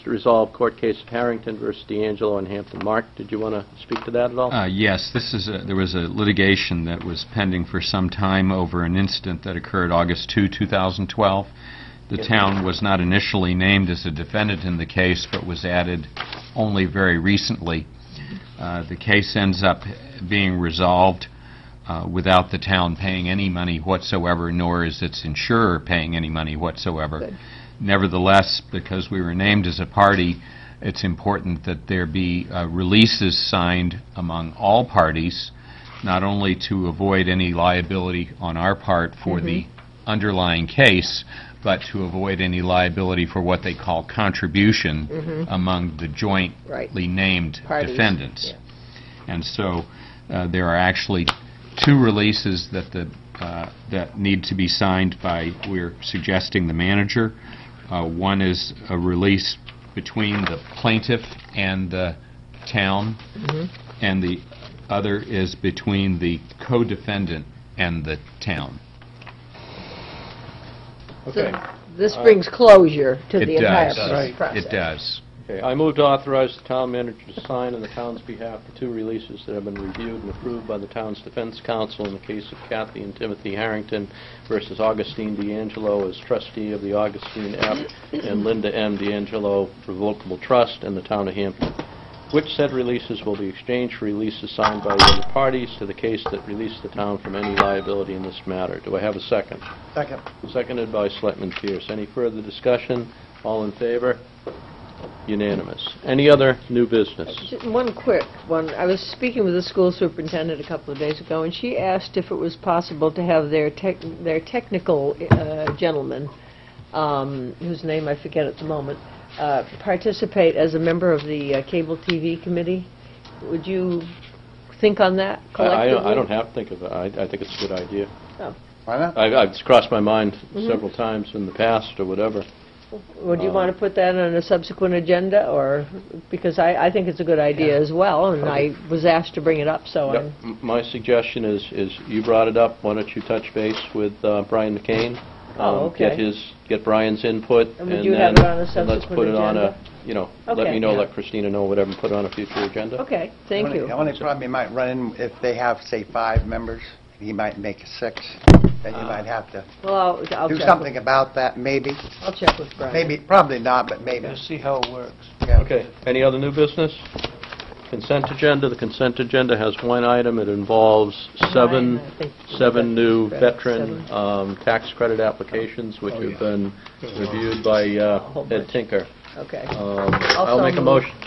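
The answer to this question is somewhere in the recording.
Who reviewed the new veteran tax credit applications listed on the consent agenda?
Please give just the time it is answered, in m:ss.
2:58.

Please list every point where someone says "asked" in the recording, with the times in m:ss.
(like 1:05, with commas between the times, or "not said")
1:51, 2:19.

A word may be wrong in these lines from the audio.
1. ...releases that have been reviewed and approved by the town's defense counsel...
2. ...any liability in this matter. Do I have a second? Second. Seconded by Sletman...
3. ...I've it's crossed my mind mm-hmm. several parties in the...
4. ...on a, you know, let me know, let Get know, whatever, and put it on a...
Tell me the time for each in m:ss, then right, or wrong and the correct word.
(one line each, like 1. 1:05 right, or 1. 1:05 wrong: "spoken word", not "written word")
1. 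1:18 right
2. 1:37 right
3. 2:09 wrong: "times", not "parties"
4. 2:29 wrong: "Christina", not "Get".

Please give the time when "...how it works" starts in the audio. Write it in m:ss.
2:44.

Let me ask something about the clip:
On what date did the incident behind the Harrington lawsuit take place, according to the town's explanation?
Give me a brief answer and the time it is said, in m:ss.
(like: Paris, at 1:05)
August 2, 2012, at 0:09.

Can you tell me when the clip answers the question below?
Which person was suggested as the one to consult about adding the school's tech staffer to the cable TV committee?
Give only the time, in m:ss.
2:24.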